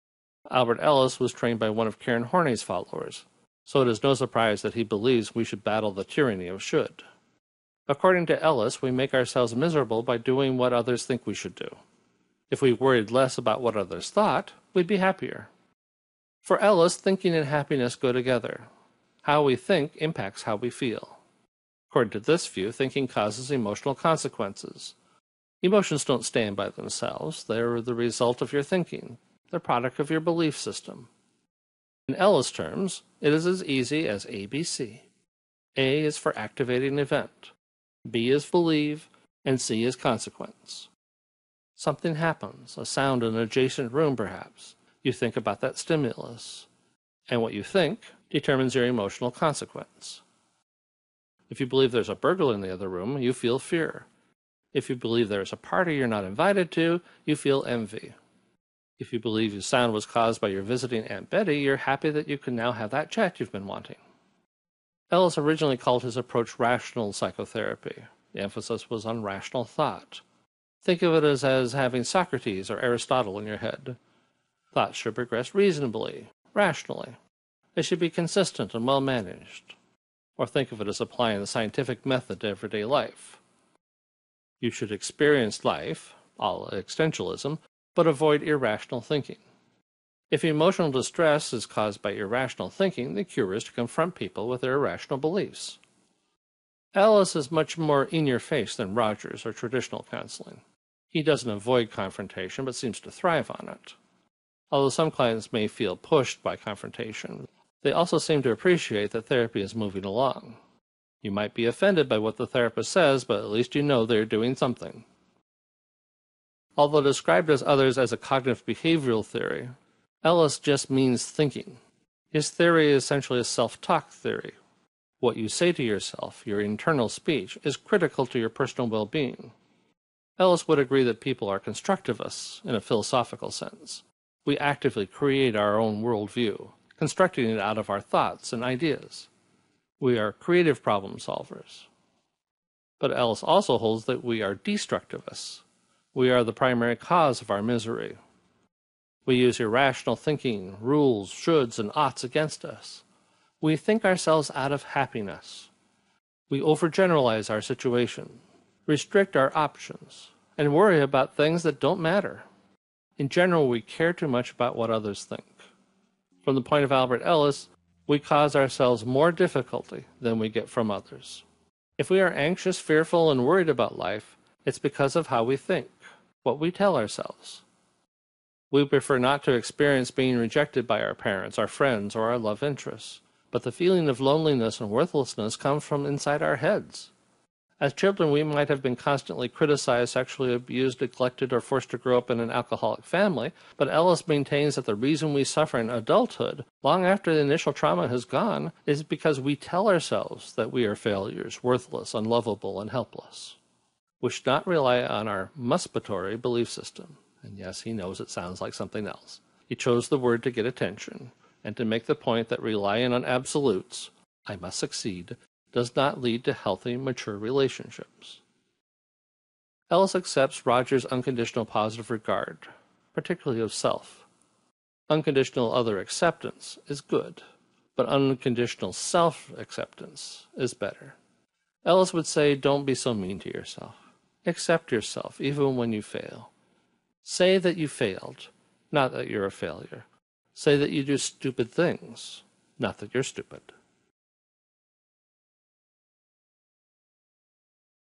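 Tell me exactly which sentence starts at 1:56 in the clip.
Although described as others as a cognitive behavioral theory, Ellis just means thinking.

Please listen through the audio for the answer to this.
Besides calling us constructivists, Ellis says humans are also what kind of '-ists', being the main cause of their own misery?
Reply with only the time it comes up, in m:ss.
2:24.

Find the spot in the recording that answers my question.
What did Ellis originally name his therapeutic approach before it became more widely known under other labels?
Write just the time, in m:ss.
1:06.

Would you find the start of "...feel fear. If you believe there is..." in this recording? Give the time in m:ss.
0:53.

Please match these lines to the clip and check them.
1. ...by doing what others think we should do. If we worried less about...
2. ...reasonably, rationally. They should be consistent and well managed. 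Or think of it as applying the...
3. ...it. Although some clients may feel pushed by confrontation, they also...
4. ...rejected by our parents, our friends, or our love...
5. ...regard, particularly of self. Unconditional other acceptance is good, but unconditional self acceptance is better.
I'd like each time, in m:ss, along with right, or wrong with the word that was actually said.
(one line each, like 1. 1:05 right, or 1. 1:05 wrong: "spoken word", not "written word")
1. 0:10 right
2. 1:15 right
3. 1:43 right
4. 3:00 right
5. 3:42 right.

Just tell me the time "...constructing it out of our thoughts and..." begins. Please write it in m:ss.
2:16.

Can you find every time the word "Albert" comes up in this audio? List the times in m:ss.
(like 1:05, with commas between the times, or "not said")
0:00, 2:46.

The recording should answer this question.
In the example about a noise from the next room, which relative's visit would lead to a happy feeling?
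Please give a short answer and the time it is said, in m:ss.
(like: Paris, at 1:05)
Aunt Betty, at 1:01.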